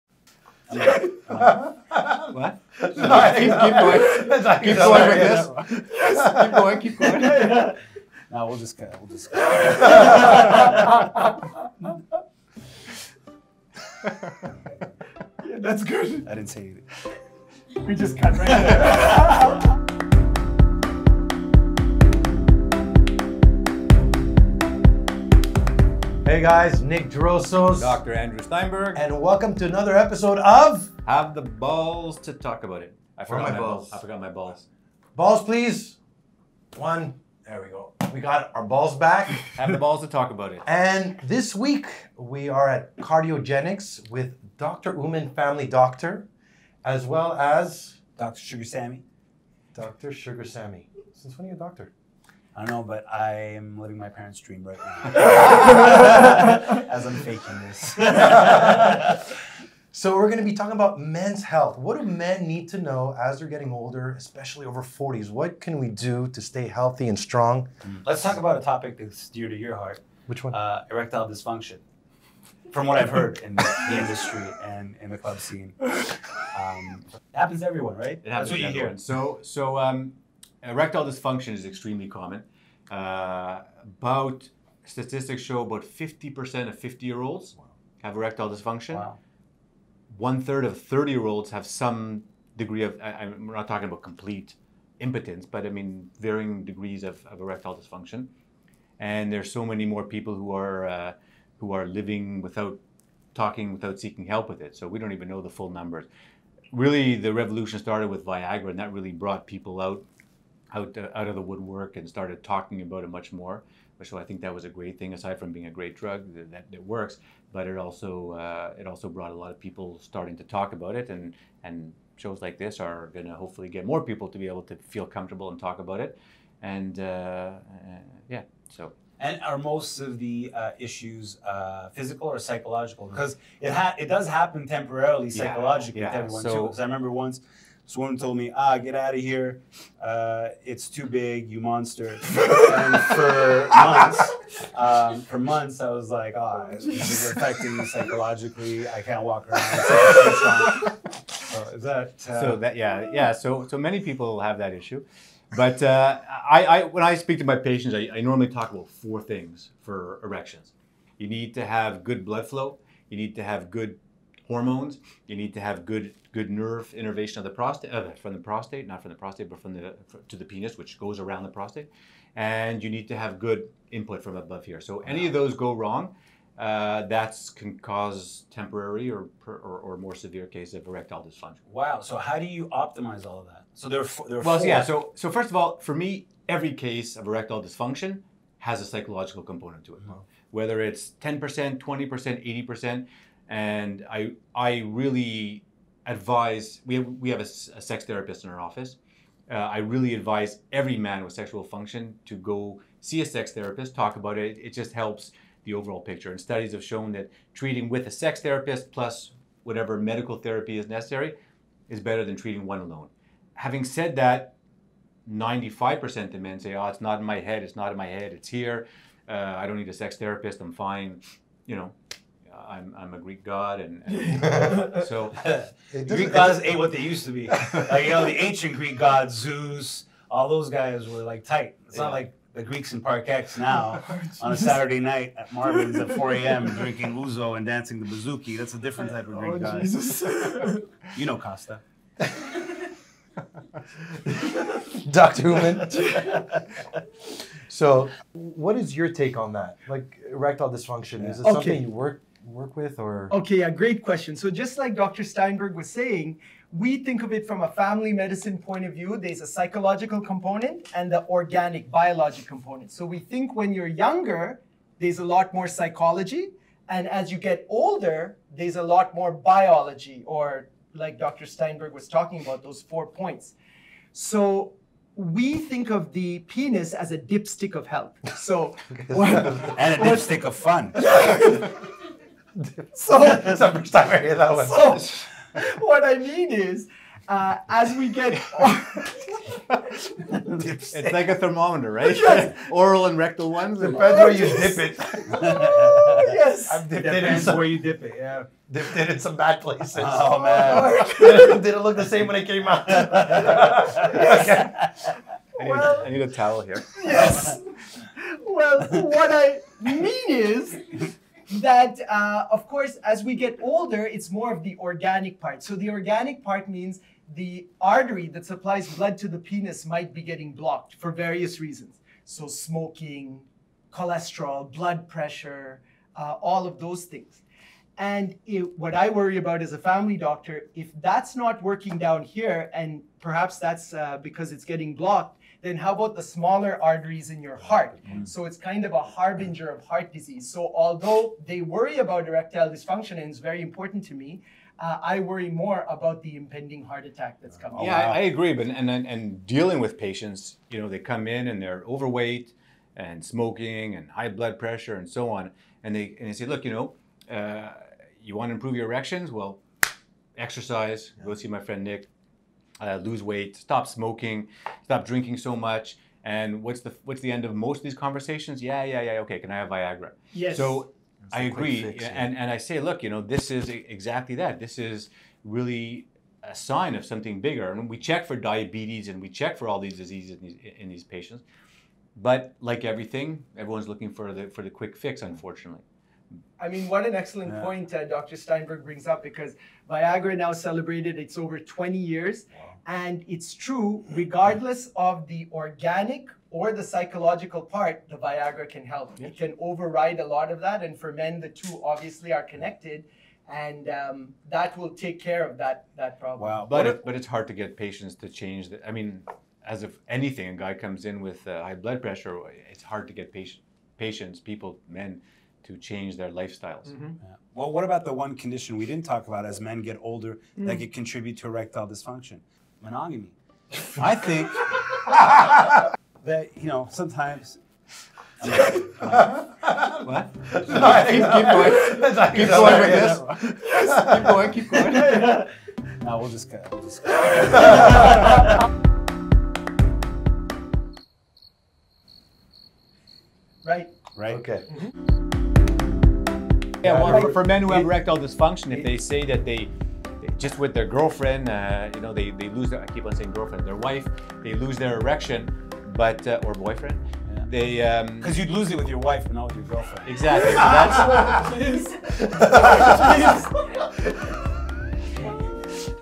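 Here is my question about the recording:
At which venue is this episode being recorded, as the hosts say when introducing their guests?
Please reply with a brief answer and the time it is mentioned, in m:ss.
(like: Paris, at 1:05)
Cardiogenics, at 0:42.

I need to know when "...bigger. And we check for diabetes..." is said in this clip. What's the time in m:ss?
6:17.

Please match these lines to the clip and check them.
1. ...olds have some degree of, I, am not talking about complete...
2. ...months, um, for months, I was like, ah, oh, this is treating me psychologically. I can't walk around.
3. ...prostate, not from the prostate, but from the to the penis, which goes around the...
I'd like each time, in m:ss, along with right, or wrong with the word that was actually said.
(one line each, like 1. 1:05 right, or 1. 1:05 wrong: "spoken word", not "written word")
1. 1:31 right
2. 2:23 wrong: "affecting", not "treating"
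3. 2:48 right.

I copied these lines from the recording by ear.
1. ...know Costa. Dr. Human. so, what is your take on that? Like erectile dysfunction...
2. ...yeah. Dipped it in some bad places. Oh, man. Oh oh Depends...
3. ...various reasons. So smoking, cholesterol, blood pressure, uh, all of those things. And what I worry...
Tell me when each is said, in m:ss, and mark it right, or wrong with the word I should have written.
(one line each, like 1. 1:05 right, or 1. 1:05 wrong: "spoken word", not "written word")
1. 4:01 right
2. 4:58 wrong: "Did", not "Depends"
3. 5:21 right.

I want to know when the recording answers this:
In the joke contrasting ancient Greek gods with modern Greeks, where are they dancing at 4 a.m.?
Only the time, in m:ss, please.
3:55.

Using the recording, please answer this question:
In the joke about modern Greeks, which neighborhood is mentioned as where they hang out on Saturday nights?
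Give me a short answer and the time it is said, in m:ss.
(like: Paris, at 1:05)
Park X, at 3:53.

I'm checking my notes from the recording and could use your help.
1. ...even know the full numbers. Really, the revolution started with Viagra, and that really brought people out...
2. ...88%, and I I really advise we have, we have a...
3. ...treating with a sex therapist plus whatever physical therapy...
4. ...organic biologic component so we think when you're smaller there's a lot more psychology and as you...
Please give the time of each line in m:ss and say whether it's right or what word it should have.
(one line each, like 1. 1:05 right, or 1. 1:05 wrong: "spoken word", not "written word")
1. 1:45 right
2. 3:12 wrong: "80", not "88"
3. 3:27 wrong: "medical", not "physical"
4. 4:21 wrong: "younger", not "smaller".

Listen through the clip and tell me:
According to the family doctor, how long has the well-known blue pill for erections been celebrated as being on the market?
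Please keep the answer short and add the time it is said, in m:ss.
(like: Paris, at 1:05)
over 20 years, at 6:31.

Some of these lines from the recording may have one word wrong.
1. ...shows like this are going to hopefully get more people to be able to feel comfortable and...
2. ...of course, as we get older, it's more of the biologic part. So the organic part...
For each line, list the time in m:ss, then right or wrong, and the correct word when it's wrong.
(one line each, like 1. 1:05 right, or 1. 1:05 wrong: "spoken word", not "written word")
1. 2:02 right
2. 5:12 wrong: "organic", not "biologic".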